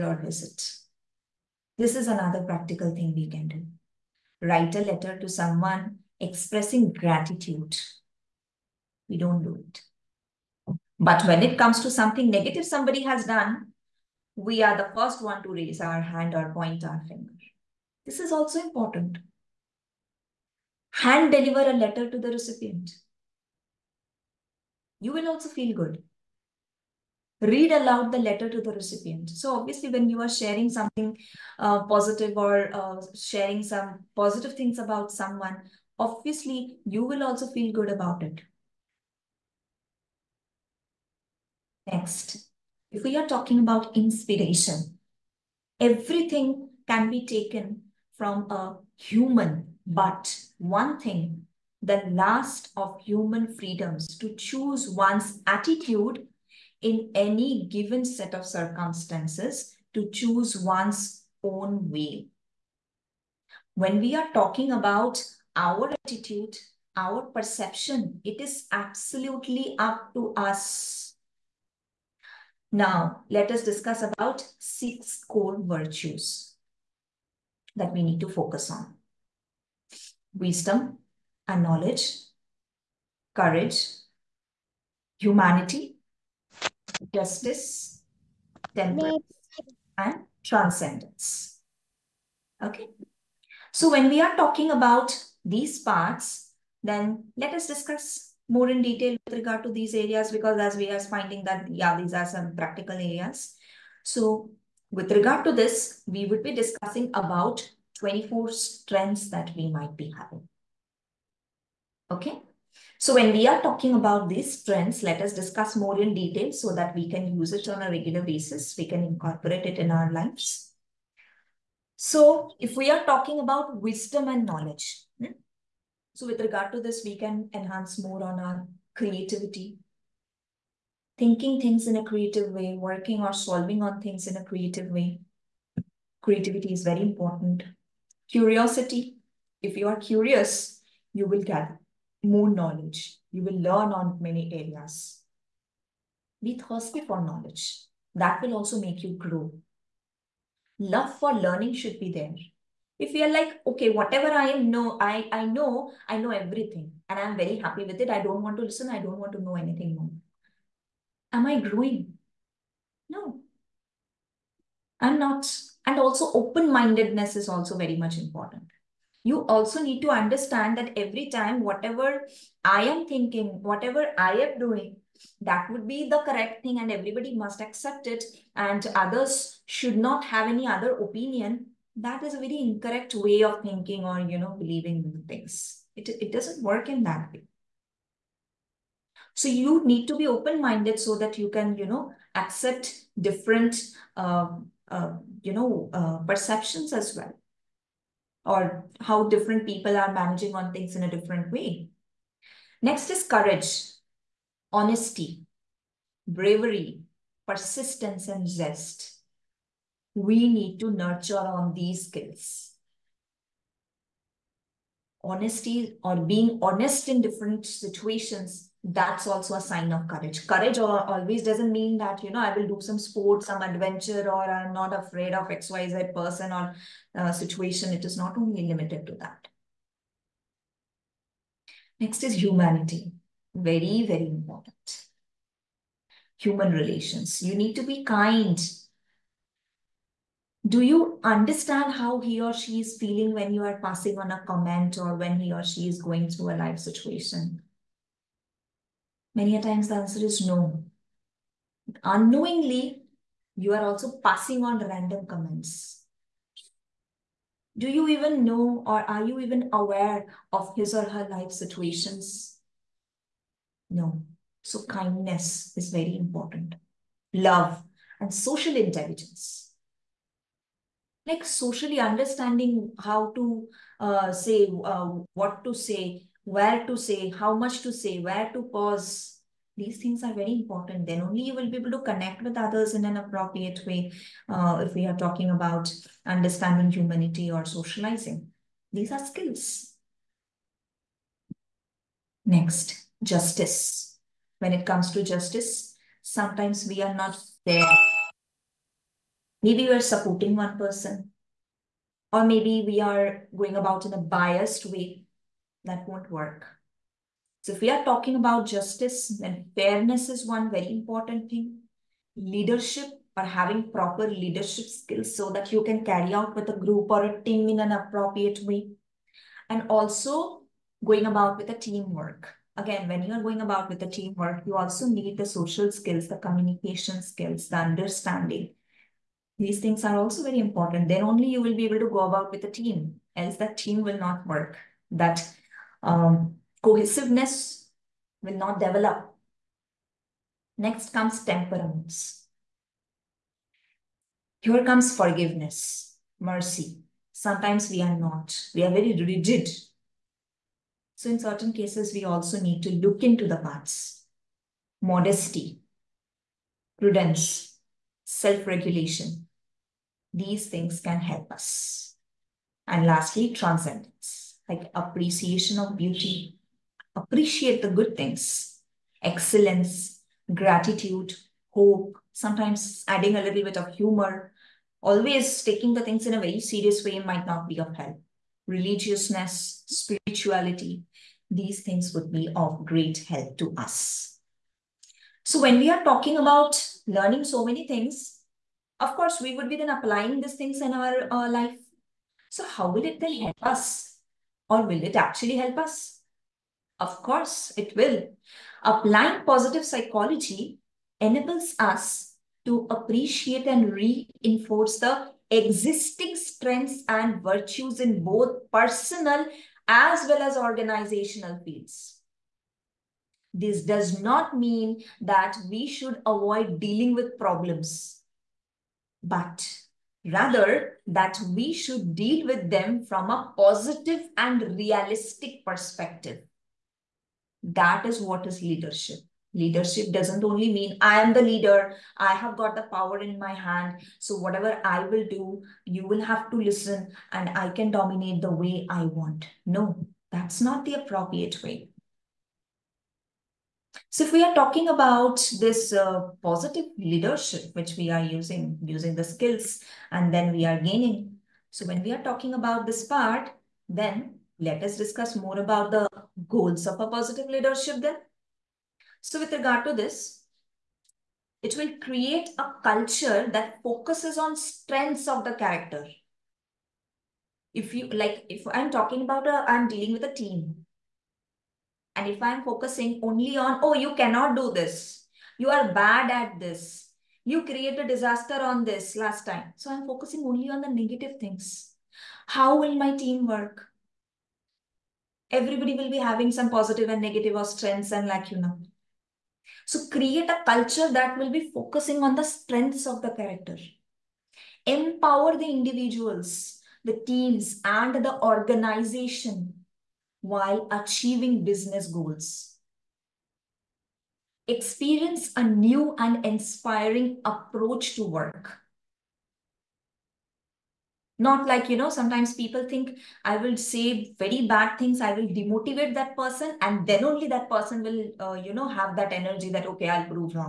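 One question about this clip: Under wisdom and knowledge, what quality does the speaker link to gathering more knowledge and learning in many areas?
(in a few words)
Curiosity.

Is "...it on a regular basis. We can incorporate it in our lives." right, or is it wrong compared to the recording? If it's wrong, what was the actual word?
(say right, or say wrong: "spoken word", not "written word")
right.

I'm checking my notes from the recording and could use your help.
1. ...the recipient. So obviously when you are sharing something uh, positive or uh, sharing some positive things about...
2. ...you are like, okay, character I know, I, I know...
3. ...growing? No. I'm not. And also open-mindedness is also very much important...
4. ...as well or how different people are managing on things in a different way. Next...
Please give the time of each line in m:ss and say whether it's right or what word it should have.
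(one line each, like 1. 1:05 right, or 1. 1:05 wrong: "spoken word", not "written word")
1. 0:28 right
2. 2:33 wrong: "whatever", not "character"
3. 2:41 right
4. 3:16 right.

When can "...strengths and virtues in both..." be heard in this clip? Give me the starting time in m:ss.
6:46.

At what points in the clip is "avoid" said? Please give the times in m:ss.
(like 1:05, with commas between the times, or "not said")
6:56.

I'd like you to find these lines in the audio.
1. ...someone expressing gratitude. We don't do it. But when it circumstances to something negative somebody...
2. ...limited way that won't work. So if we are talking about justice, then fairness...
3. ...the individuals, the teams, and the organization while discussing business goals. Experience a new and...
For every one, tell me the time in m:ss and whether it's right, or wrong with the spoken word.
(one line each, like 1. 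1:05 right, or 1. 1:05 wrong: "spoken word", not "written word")
1. 0:05 wrong: "comes", not "circumstances"
2. 5:04 wrong: "biased", not "limited"
3. 8:15 wrong: "achieving", not "discussing".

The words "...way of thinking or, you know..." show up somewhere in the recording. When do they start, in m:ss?
3:03.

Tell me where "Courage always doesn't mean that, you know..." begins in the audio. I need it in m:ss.
3:40.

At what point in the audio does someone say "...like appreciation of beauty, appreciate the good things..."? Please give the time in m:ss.
6:04.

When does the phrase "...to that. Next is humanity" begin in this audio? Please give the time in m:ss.
3:49.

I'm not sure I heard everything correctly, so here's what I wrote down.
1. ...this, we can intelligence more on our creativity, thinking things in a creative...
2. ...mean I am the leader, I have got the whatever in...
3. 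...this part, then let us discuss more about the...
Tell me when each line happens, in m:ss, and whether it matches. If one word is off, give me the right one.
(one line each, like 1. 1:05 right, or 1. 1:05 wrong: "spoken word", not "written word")
1. 2:06 wrong: "enhance", not "intelligence"
2. 7:10 wrong: "power", not "whatever"
3. 7:32 right.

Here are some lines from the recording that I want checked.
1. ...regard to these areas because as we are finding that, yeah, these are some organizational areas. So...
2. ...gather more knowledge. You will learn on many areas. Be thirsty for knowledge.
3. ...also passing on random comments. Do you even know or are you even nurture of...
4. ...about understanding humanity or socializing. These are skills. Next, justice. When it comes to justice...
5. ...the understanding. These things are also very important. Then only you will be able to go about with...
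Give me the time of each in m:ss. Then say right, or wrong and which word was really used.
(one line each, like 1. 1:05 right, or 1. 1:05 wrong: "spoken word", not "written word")
1. 1:39 wrong: "practical", not "organizational"
2. 2:21 right
3. 4:13 wrong: "aware", not "nurture"
4. 4:45 right
5. 5:27 right.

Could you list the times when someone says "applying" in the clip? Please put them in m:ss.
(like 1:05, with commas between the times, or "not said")
6:29, 6:38.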